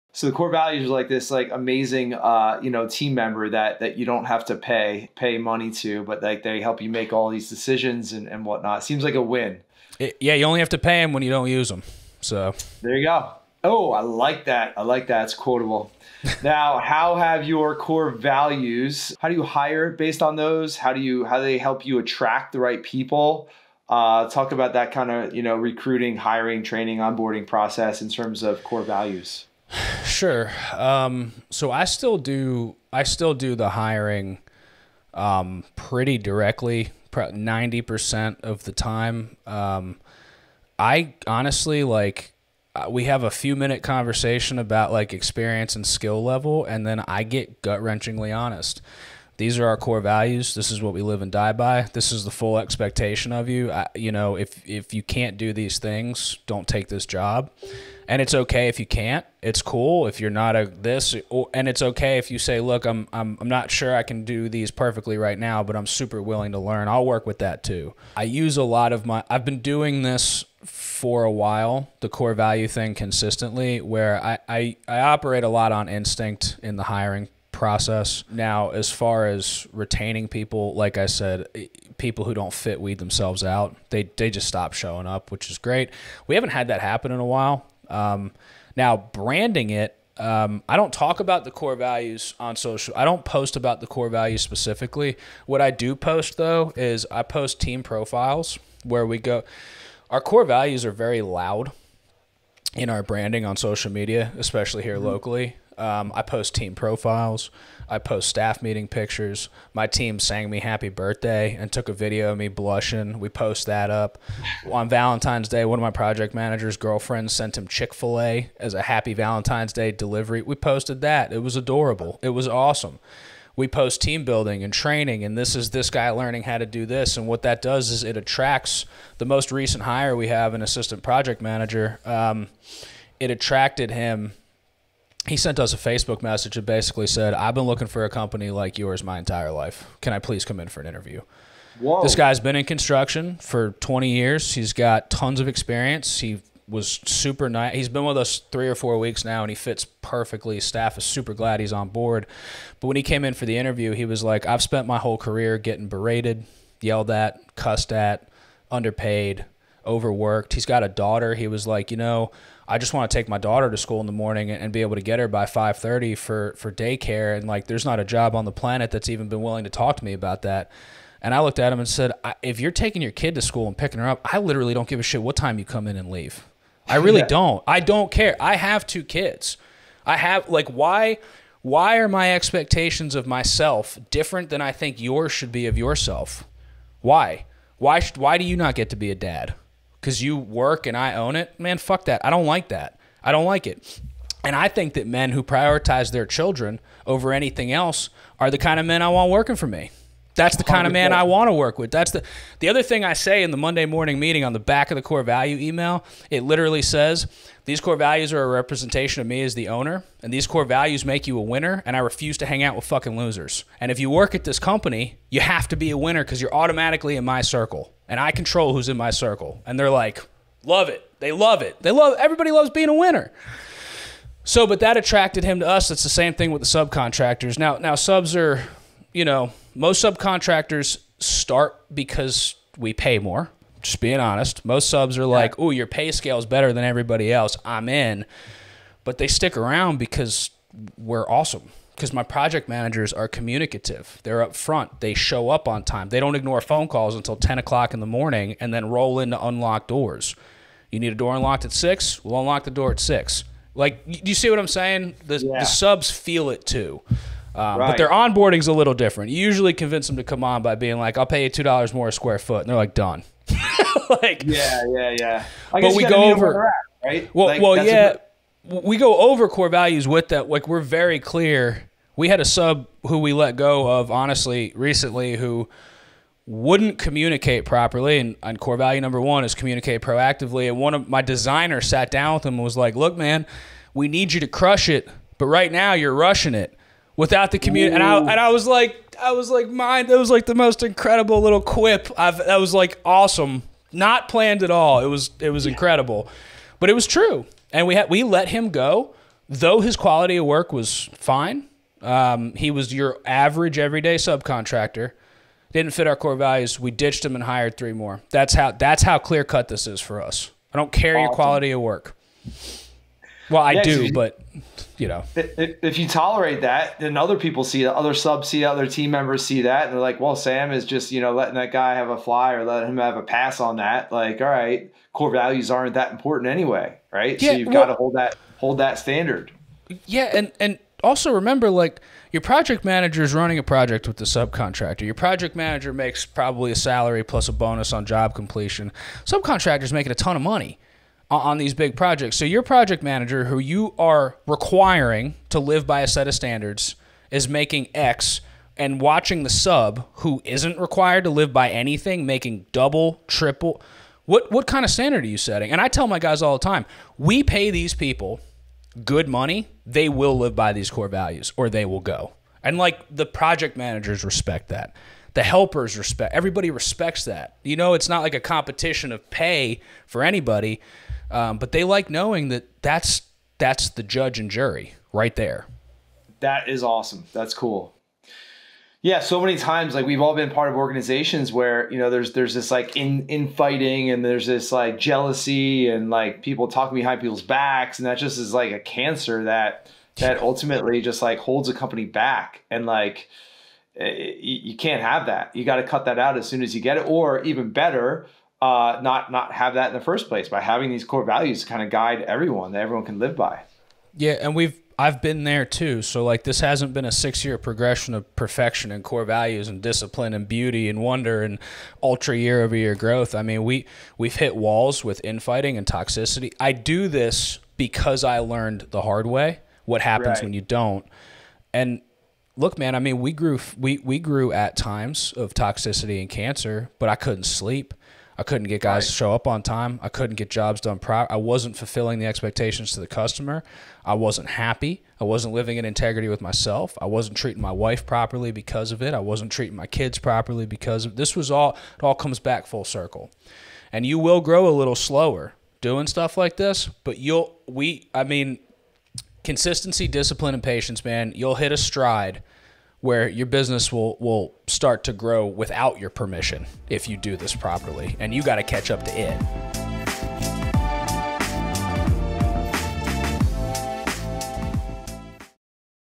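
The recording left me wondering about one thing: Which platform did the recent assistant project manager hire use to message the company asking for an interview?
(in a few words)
Facebook.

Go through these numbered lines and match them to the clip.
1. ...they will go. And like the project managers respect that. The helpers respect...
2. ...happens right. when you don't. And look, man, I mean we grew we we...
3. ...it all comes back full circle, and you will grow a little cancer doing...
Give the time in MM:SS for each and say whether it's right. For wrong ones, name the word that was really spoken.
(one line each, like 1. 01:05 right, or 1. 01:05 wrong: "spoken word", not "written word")
1. 06:01 right
2. 07:00 right
3. 07:21 wrong: "slower", not "cancer".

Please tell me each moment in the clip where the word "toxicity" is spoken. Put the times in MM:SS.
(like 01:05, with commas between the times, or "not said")
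06:55, 07:05.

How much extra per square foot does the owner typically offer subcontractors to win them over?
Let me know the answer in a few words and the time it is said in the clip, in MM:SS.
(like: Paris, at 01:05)
$2, at 04:21.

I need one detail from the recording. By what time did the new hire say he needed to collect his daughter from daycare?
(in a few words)
5:30.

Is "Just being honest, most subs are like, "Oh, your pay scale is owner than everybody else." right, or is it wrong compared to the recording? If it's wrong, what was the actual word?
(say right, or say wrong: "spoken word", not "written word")
wrong: "better", not "owner".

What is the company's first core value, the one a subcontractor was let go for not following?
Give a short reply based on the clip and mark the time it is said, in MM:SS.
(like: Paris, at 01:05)
Communicate proactively, at 04:39.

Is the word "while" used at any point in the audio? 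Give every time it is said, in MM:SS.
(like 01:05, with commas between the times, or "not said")
01:11, 01:27.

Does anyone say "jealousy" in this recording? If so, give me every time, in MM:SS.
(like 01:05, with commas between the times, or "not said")
06:24.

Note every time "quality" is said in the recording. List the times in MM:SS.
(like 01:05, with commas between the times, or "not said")
04:59, 05:11.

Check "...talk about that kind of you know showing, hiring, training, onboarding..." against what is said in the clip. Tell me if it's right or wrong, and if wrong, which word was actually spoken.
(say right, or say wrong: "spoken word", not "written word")
wrong: "recruiting", not "showing".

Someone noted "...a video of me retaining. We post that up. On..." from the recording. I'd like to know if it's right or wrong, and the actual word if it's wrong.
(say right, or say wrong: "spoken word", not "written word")
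wrong: "blushing", not "retaining".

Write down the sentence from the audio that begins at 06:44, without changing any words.
Yeah, and we've I've been there too.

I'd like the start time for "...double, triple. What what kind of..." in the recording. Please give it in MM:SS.
05:52.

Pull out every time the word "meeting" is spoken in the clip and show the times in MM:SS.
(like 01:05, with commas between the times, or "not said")
01:48, 03:24.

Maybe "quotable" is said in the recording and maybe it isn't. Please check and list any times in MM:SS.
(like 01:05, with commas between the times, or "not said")
00:15.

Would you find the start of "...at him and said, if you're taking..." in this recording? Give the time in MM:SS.
02:51.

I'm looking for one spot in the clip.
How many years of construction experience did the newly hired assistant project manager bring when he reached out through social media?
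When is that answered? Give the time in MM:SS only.
02:23.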